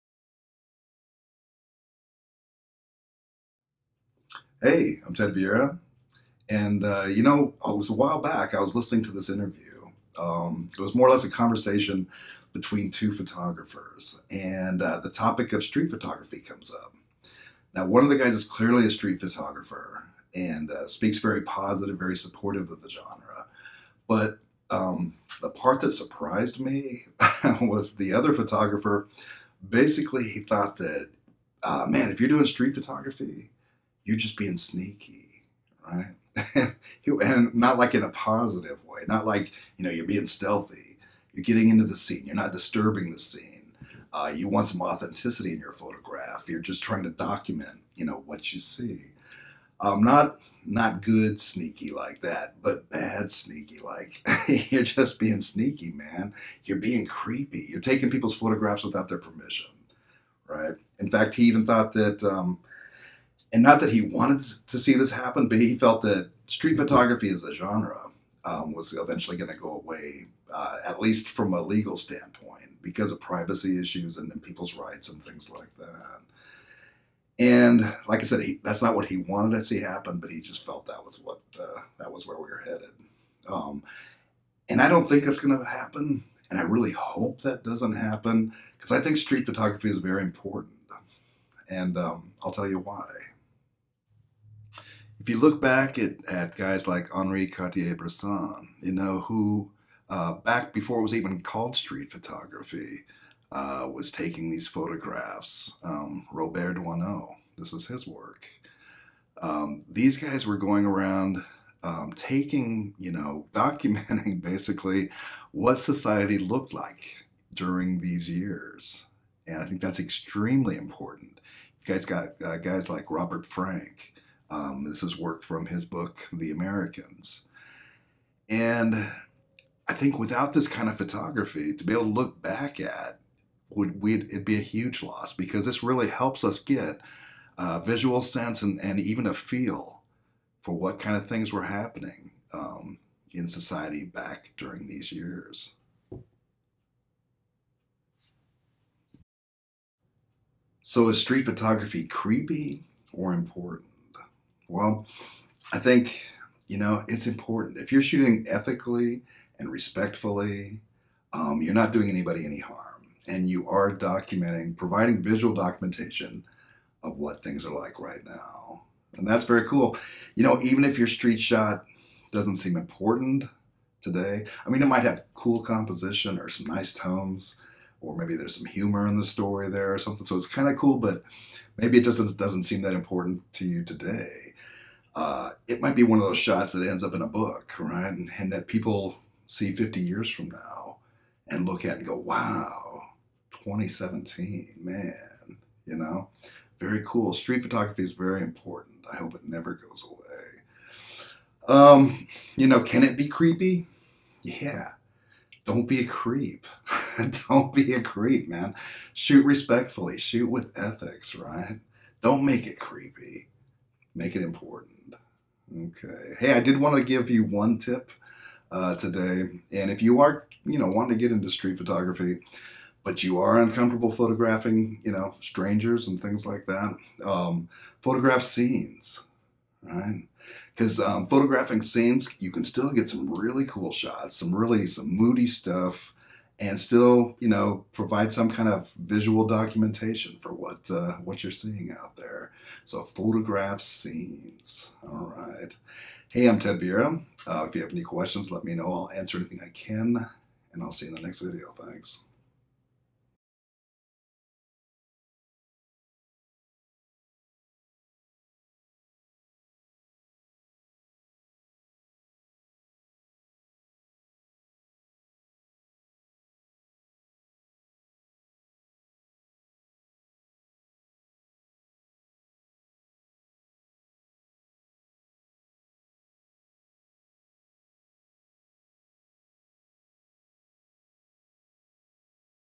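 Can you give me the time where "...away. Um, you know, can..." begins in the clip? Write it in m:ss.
3:20.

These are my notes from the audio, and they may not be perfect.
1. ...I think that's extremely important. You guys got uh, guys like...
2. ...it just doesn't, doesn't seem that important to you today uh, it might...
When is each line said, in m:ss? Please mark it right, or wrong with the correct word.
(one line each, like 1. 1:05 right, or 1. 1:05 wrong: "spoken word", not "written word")
1. 1:59 right
2. 3:01 right.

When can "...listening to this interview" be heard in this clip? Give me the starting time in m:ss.
0:08.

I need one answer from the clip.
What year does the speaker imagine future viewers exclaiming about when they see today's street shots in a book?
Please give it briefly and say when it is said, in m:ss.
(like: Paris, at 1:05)
2017, at 3:13.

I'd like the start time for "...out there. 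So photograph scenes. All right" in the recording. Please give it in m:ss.
4:01.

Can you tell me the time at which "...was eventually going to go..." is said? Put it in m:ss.
1:08.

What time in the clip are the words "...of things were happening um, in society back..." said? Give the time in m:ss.
2:21.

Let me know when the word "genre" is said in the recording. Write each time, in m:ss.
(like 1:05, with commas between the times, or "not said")
0:22, 1:07.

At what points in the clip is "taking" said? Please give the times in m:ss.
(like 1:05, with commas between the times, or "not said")
0:57, 1:44, 1:52.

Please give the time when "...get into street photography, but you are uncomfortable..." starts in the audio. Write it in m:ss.
3:41.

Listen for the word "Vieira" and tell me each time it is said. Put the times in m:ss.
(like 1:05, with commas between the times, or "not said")
0:05, 4:06.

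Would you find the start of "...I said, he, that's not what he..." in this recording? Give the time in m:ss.
1:18.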